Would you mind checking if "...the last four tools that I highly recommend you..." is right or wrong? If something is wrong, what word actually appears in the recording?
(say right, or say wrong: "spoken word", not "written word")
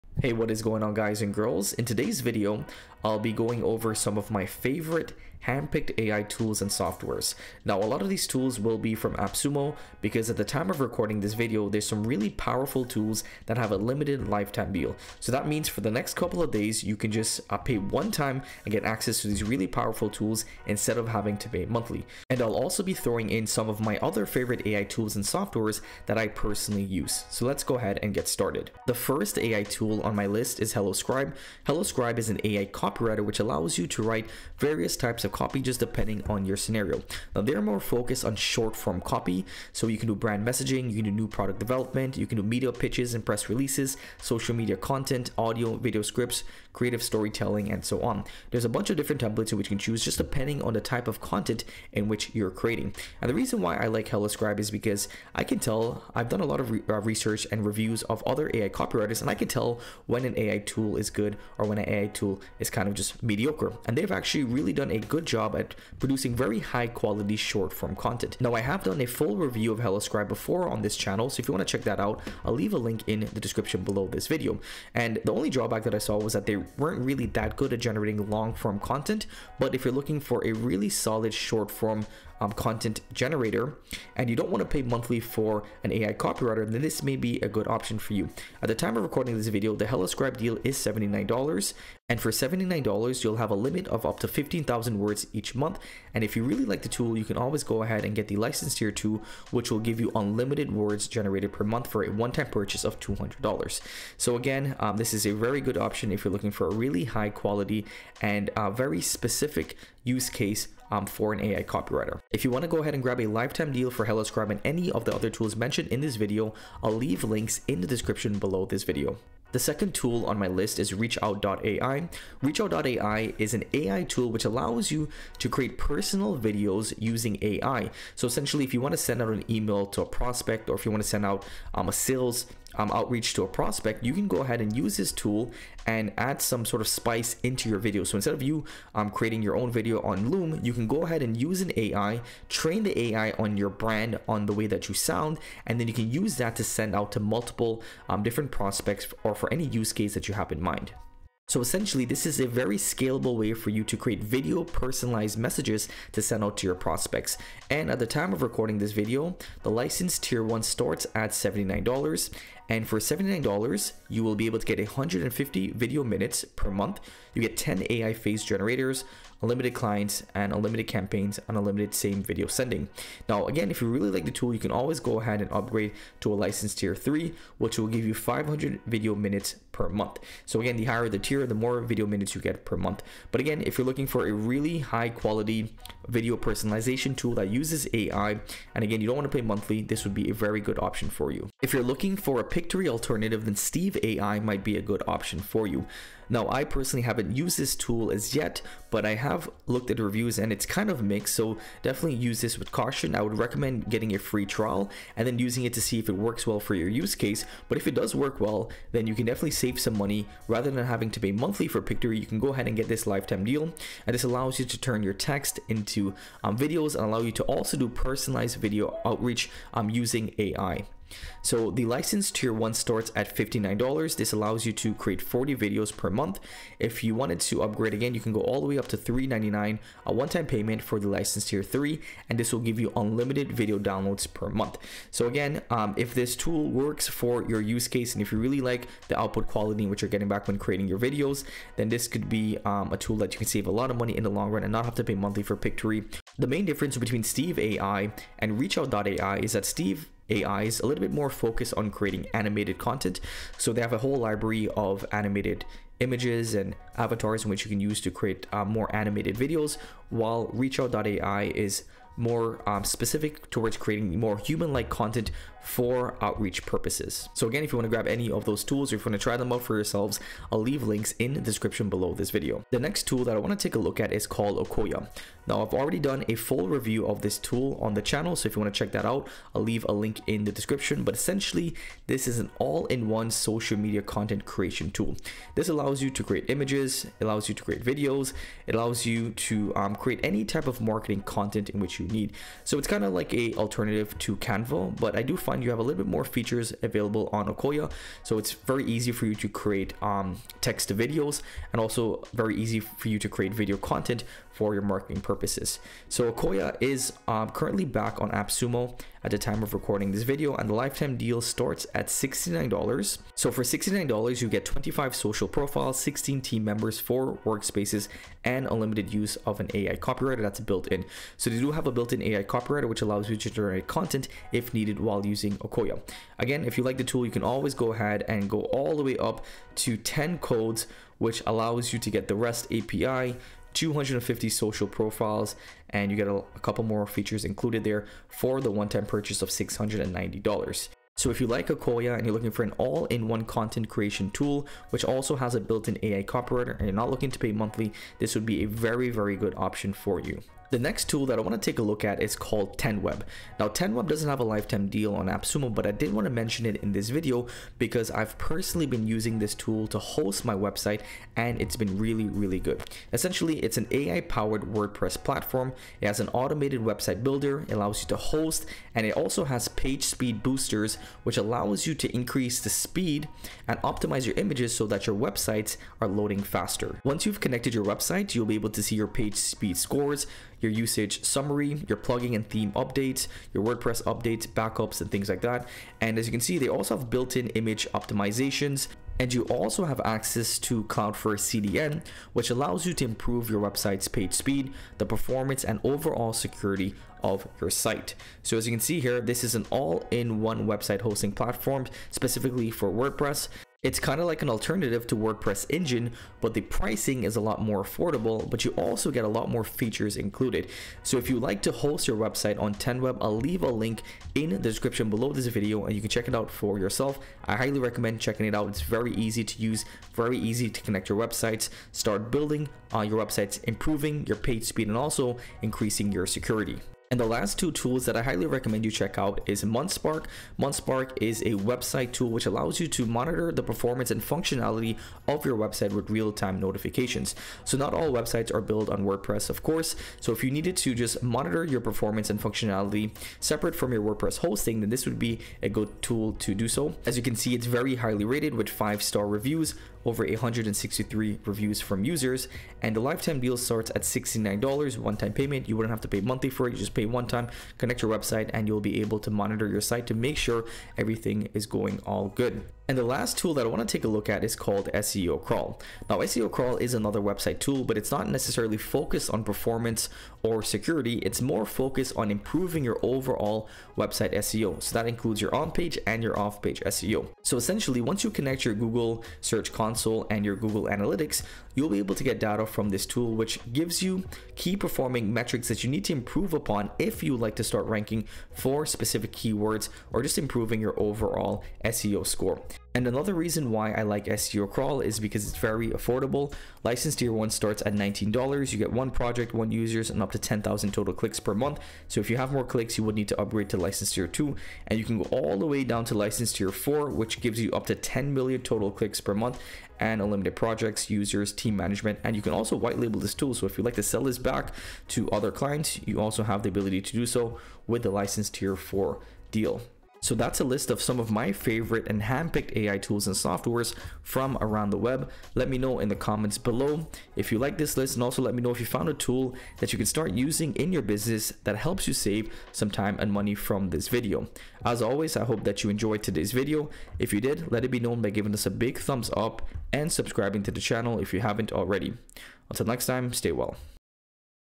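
wrong: "two", not "four".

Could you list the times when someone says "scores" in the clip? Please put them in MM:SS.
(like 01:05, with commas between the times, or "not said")
06:19, 08:12.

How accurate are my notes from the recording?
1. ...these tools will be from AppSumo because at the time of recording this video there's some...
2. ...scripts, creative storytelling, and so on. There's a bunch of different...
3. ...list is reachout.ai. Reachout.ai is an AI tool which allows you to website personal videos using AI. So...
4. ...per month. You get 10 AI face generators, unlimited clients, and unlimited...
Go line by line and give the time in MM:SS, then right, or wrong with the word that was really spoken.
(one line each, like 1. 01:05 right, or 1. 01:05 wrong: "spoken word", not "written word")
1. 00:08 right
2. 00:46 right
3. 02:00 wrong: "create", not "website"
4. 02:46 right.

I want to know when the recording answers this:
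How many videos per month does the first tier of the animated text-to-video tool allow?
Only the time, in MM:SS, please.
03:45.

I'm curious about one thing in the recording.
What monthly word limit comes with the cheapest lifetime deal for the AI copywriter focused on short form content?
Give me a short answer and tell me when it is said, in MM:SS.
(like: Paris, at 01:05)
15,000 words, at 01:34.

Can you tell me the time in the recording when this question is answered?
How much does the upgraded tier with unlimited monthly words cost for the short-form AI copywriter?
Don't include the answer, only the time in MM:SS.
01:42.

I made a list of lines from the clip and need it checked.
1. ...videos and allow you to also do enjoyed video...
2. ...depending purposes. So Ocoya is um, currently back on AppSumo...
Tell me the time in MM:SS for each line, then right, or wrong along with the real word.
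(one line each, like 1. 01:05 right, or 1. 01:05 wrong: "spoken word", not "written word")
1. 03:36 wrong: "personalized", not "enjoyed"
2. 05:04 wrong: "marketing", not "depending".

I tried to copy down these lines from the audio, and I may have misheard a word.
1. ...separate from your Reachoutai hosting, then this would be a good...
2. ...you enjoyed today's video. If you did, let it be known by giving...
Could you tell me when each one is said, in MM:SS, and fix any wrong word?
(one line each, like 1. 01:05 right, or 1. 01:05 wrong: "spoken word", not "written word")
1. 07:23 wrong: "WordPress", not "Reachoutai"
2. 08:55 right.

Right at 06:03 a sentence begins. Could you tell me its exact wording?
Essentially, it's an AI powered WordPress platform.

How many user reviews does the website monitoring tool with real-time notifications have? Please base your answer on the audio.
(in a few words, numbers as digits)
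863.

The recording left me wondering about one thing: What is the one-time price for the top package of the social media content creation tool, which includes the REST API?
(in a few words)
$690.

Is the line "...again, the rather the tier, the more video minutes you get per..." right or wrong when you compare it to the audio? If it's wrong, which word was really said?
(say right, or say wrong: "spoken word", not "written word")
wrong: "higher", not "rather".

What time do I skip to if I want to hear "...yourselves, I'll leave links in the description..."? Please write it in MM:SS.
04:29.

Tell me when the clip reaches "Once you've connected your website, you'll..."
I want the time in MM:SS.
06:17.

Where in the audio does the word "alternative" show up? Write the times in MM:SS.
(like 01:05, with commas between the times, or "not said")
03:12, 04:53, 06:44.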